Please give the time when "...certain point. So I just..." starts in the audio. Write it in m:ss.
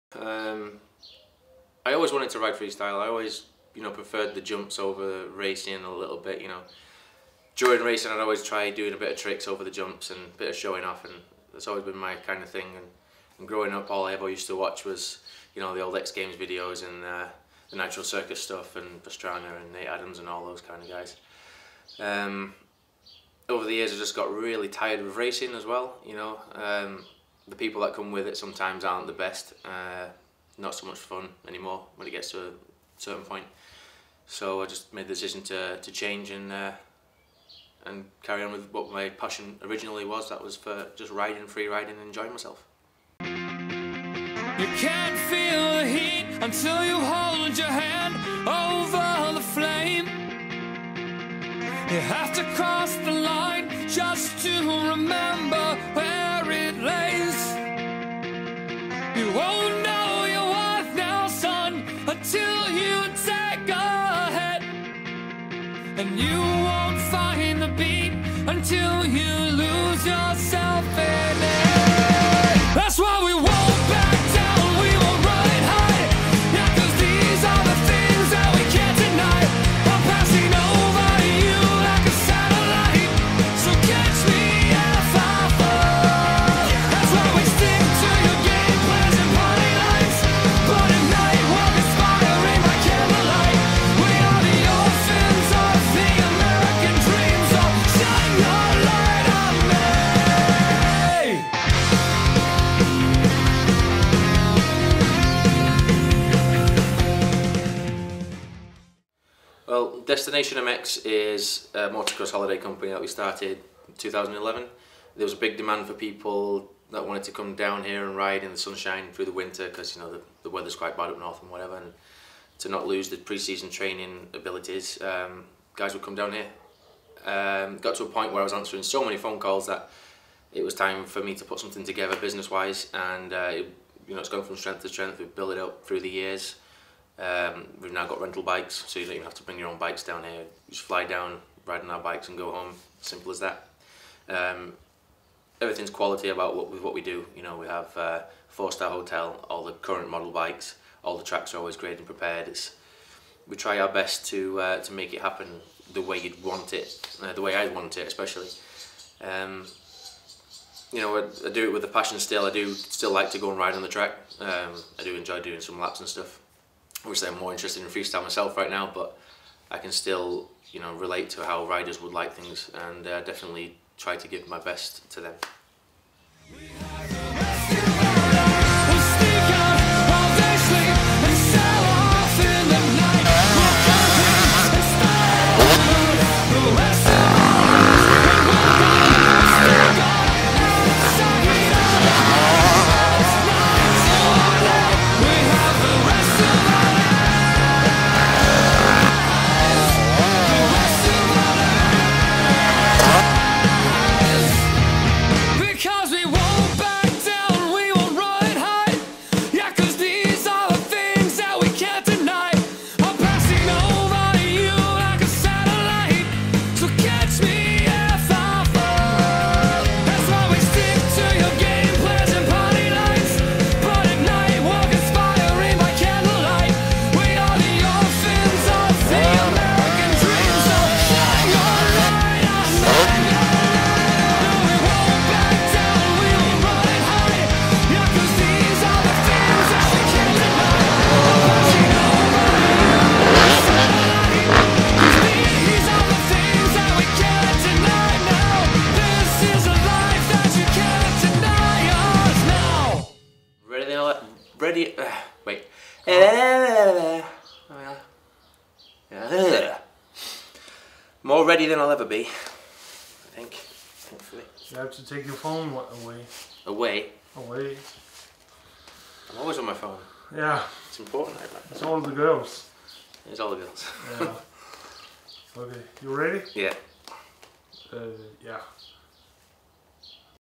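0:32.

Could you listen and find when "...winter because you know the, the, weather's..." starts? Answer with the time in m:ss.
1:59.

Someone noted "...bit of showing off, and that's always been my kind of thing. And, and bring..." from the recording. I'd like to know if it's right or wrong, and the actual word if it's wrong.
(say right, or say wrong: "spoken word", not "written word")
wrong: "growing", not "bring".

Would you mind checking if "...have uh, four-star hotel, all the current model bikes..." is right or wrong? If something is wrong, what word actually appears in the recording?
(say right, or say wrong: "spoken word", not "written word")
right.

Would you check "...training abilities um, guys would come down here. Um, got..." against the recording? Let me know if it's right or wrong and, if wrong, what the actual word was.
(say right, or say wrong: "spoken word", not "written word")
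right.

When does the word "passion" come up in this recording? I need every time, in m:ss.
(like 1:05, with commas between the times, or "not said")
0:39, 2:41.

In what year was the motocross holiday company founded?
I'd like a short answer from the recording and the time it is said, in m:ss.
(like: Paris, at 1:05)
2011, at 1:53.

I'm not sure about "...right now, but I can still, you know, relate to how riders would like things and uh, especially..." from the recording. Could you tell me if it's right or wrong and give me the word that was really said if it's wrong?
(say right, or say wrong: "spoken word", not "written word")
wrong: "definitely", not "especially".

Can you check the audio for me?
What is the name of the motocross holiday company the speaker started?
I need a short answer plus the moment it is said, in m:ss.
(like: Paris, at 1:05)
Destination MX, at 1:50.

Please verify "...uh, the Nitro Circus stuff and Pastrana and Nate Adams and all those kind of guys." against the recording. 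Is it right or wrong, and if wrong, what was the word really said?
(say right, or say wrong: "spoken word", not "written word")
right.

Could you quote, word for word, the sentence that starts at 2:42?
I do still like to go and ride on the track.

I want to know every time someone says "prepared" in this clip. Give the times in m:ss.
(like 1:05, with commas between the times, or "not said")
2:32.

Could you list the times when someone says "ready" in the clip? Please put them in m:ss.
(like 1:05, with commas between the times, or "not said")
4:14, 4:21, 4:36.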